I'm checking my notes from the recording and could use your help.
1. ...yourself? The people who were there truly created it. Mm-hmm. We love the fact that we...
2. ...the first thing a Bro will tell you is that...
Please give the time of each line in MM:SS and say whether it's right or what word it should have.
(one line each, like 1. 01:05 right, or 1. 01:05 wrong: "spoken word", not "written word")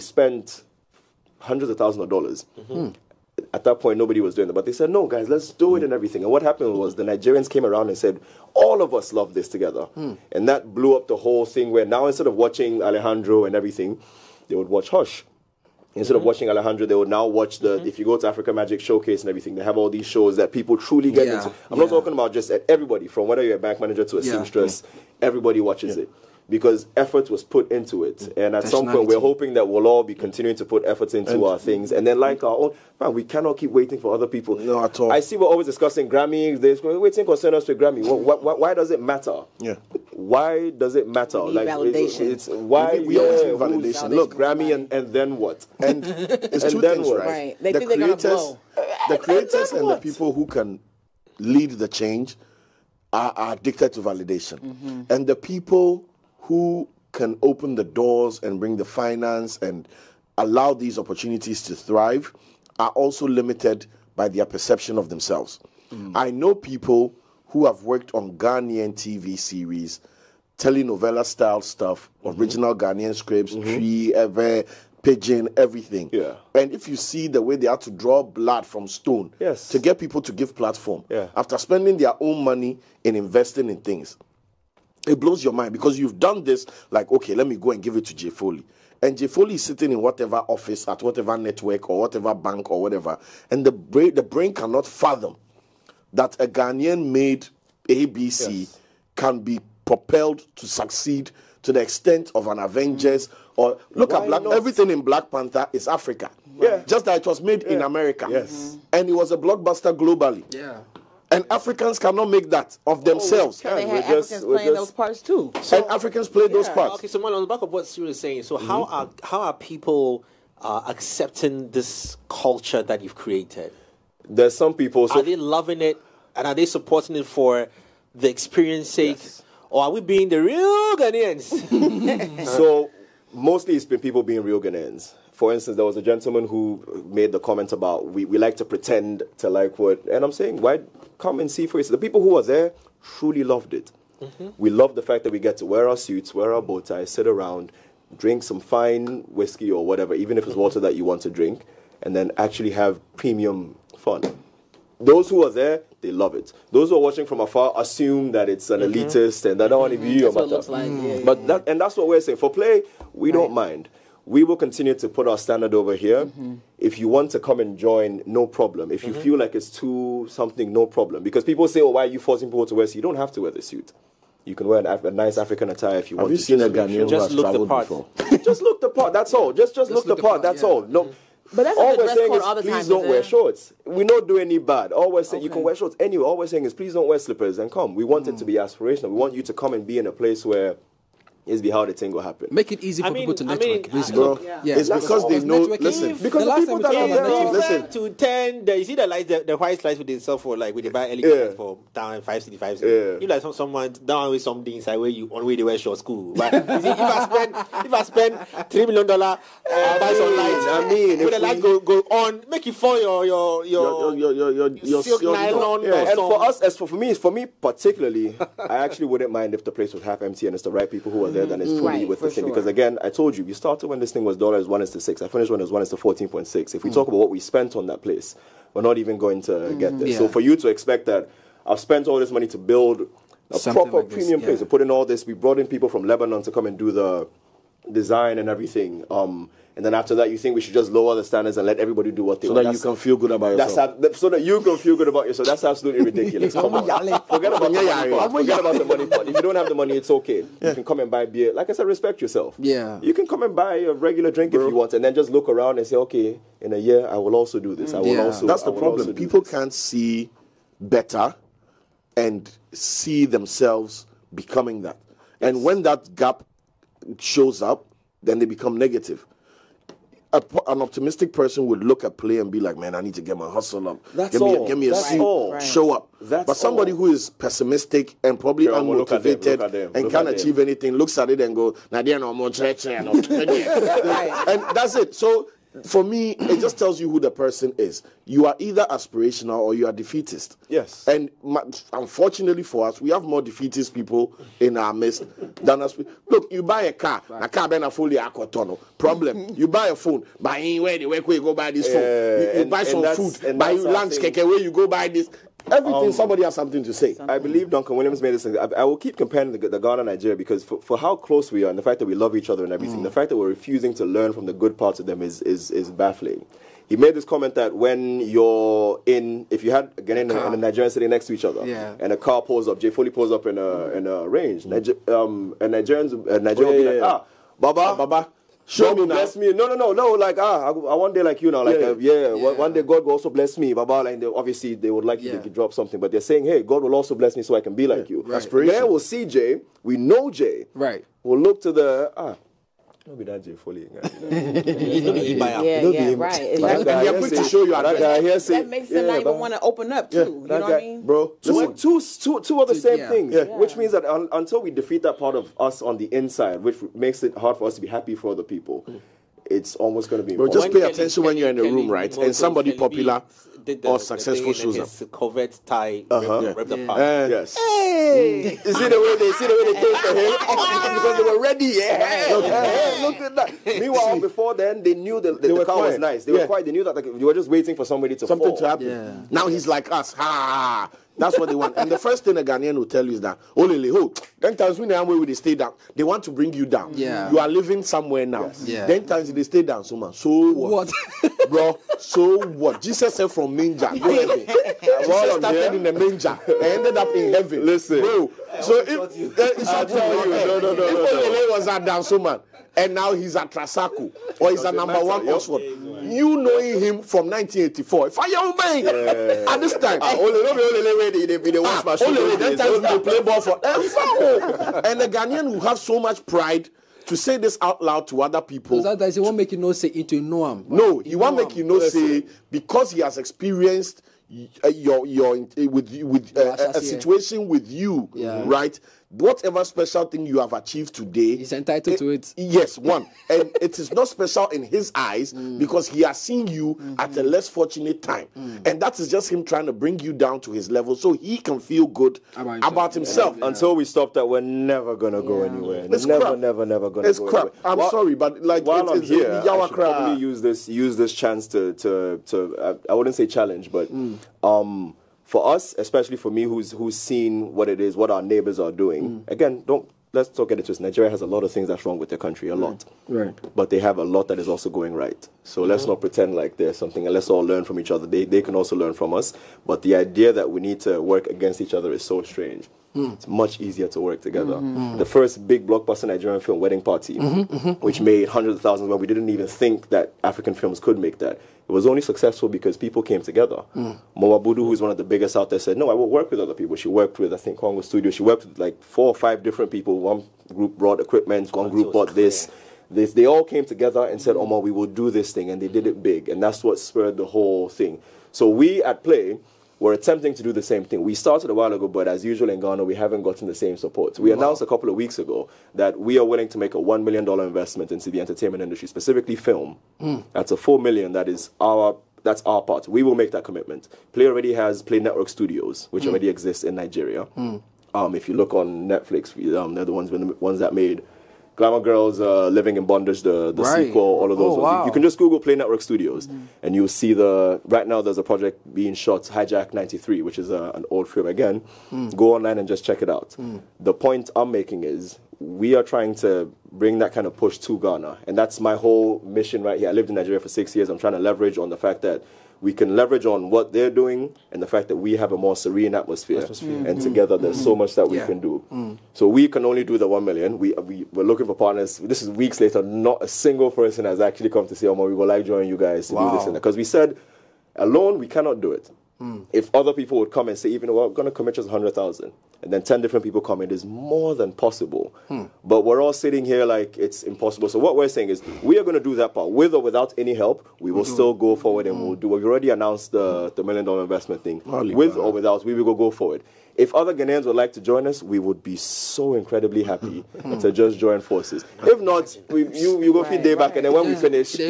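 1. 02:21 wrong: "loved", not "created"
2. 06:21 wrong: "Ghanaian", not "Bro".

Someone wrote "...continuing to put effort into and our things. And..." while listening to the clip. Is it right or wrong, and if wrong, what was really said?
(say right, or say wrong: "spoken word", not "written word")
right.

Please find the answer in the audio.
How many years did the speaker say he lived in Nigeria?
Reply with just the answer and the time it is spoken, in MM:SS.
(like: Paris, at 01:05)
6, at 09:00.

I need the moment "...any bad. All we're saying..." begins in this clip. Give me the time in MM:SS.
03:04.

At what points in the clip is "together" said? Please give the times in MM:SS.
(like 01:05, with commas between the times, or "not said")
00:09, 07:54, 08:03, 08:13, 09:07.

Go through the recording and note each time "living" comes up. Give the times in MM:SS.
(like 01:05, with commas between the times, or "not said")
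06:27, 08:42.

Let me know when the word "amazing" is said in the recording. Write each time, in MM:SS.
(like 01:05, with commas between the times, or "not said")
not said.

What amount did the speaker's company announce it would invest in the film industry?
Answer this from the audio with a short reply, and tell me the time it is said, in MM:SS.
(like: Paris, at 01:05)
$1 million, at 08:26.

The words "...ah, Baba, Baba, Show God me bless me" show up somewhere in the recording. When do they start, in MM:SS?
05:27.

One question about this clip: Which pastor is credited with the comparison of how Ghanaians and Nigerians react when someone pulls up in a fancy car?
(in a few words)
Duncan Williams.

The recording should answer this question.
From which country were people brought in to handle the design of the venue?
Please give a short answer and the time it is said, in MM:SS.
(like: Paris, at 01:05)
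Lebanon, at 03:56.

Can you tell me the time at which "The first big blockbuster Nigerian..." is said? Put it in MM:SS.
07:54.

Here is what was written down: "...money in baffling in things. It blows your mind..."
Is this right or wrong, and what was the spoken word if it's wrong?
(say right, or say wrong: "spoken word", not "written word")
wrong: "investing", not "baffling".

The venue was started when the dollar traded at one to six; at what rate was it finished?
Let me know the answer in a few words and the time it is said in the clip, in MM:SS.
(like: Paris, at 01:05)
14.6, at 03:45.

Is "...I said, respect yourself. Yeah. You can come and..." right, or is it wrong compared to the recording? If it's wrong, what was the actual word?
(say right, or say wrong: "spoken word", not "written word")
right.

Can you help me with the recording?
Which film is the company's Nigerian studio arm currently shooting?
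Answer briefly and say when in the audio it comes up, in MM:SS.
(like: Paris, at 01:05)
Hijack '93, at 08:49.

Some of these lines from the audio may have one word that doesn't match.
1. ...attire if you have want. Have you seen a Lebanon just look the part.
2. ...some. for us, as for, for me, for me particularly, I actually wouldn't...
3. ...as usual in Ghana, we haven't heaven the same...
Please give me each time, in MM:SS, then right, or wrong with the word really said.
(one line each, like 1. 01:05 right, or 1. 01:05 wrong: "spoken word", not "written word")
1. 02:55 wrong: "Ghanaian", not "Lebanon"
2. 03:36 right
3. 08:22 wrong: "gotten", not "heaven".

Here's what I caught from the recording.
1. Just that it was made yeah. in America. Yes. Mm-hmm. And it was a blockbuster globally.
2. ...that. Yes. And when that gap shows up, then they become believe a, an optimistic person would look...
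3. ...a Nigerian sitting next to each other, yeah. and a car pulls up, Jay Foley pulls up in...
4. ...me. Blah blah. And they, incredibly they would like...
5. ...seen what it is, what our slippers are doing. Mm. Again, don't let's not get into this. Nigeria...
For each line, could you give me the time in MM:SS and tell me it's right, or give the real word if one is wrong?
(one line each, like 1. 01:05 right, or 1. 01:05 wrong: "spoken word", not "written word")
1. 01:46 right
2. 04:24 wrong: "negative", not "believe"
3. 05:20 right
4. 05:33 wrong: "obviously", not "incredibly"
5. 07:36 wrong: "neighbors", not "slippers".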